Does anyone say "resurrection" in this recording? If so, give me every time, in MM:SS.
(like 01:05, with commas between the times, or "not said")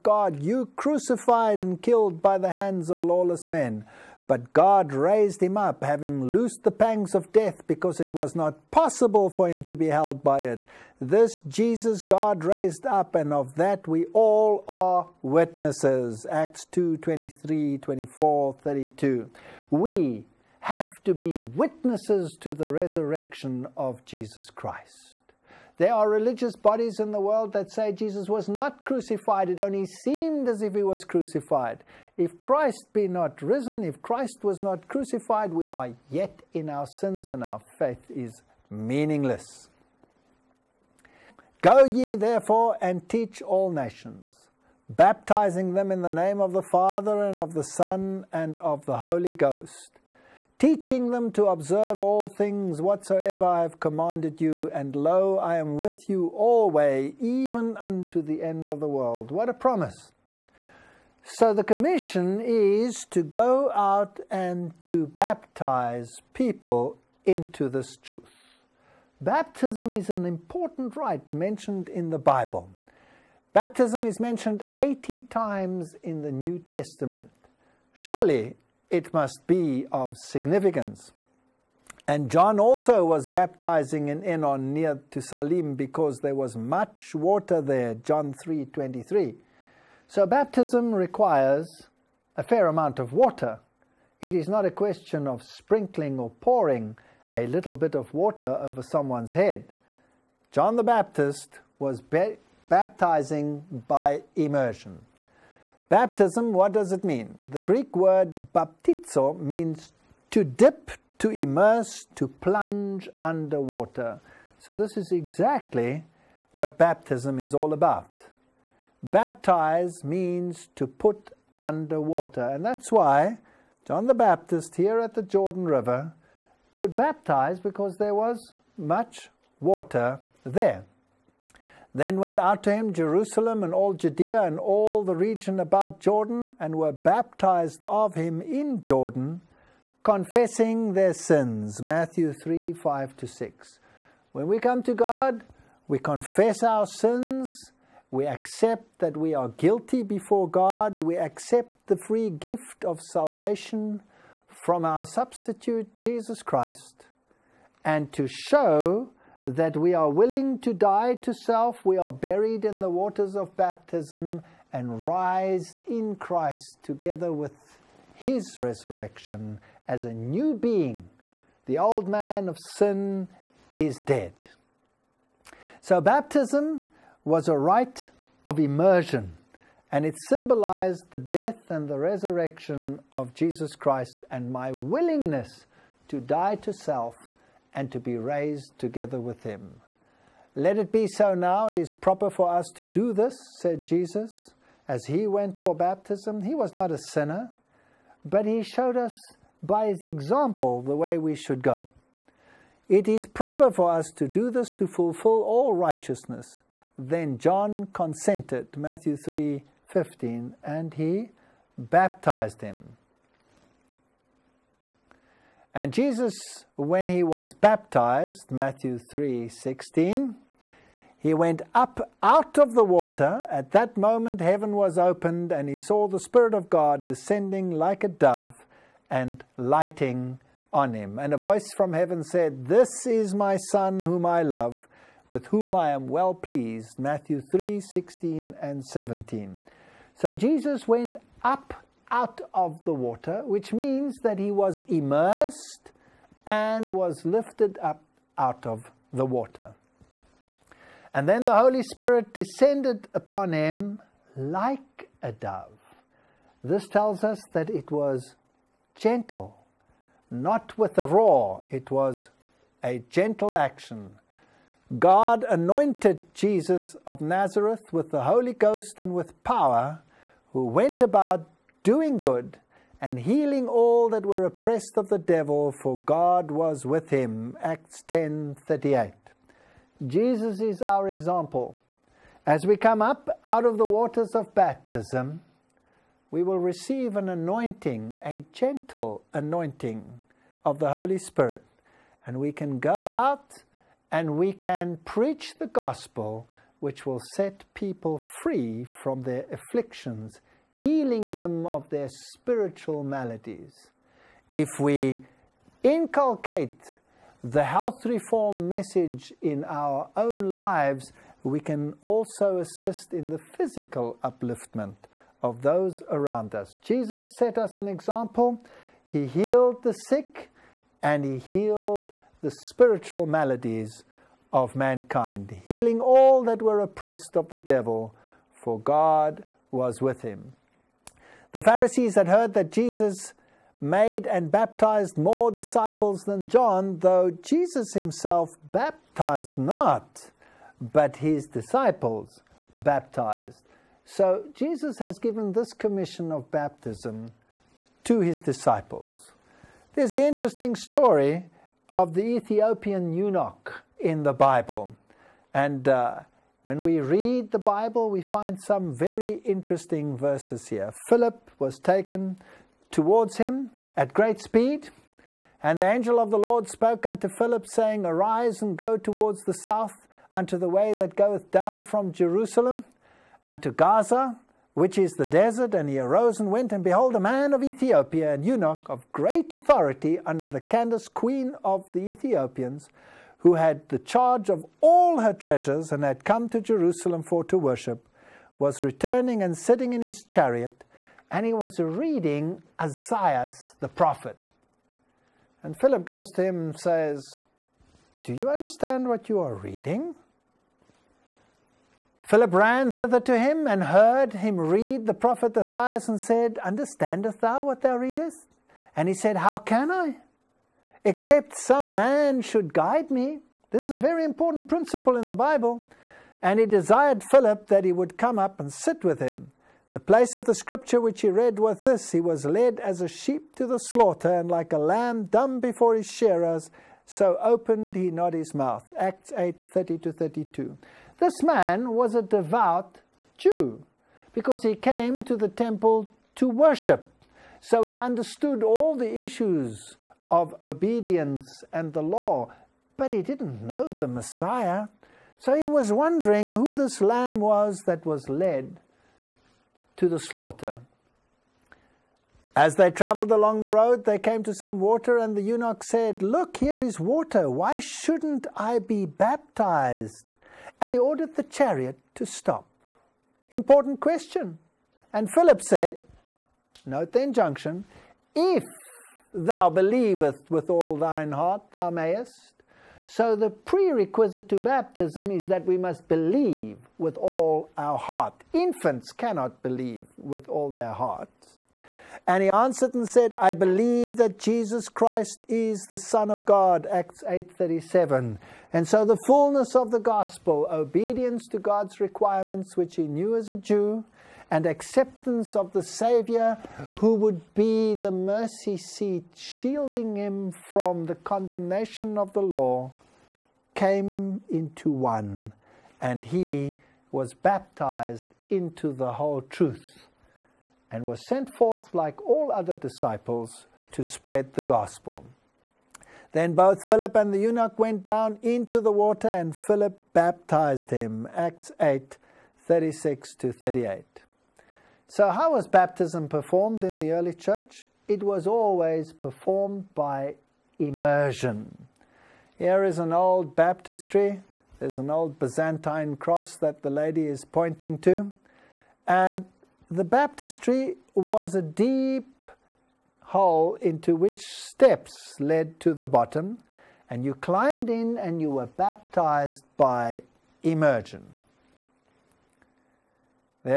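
00:22, 02:48, 03:01.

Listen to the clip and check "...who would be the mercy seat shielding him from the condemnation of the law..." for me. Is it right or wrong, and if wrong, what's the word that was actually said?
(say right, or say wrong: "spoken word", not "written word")
right.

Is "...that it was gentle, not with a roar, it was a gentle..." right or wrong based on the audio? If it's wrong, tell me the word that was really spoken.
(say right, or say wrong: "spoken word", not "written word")
right.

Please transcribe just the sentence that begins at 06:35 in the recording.
And Philip goes to him and says, Do you understand what you are reading?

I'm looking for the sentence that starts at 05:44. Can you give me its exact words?
So Jesus has given this commission of baptism to his disciples.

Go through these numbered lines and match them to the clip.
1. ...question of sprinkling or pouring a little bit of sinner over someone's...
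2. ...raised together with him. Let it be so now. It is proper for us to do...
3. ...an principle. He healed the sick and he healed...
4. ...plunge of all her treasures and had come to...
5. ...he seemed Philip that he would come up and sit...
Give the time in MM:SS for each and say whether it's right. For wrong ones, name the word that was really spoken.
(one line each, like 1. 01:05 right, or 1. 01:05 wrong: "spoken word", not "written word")
1. 01:34 wrong: "water", not "sinner"
2. 03:08 right
3. 05:17 wrong: "example", not "principle"
4. 06:23 wrong: "charge", not "plunge"
5. 06:56 wrong: "desired", not "seemed".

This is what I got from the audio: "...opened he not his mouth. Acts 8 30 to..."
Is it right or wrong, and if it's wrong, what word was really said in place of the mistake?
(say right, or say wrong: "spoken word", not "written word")
right.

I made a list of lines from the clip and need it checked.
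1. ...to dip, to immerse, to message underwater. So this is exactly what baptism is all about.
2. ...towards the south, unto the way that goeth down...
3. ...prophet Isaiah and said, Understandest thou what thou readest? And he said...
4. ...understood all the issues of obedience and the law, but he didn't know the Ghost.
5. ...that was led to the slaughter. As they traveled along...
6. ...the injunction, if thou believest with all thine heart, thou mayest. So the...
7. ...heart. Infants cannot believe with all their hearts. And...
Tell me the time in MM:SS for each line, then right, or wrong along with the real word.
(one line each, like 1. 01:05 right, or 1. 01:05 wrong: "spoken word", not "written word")
1. 01:50 wrong: "plunge", not "message"
2. 06:08 right
3. 06:45 right
4. 07:17 wrong: "Messiah", not "Ghost"
5. 07:27 right
6. 07:47 right
7. 07:57 right.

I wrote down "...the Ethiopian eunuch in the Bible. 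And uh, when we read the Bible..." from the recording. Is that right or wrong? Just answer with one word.
right.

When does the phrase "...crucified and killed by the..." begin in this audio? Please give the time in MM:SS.
00:00.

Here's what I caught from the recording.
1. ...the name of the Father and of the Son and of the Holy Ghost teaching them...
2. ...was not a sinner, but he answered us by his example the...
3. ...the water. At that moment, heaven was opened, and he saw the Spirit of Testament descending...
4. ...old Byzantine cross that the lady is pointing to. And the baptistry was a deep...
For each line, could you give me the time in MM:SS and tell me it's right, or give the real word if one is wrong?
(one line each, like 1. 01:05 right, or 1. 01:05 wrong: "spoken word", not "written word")
1. 00:46 right
2. 03:16 wrong: "showed", not "answered"
3. 03:42 wrong: "God", not "Testament"
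4. 08:55 right.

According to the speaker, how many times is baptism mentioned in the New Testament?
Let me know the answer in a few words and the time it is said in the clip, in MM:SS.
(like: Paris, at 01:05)
80, at 01:14.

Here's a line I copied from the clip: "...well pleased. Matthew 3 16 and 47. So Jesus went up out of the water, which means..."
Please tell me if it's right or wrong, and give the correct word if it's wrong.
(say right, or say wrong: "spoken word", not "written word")
wrong: "17", not "47".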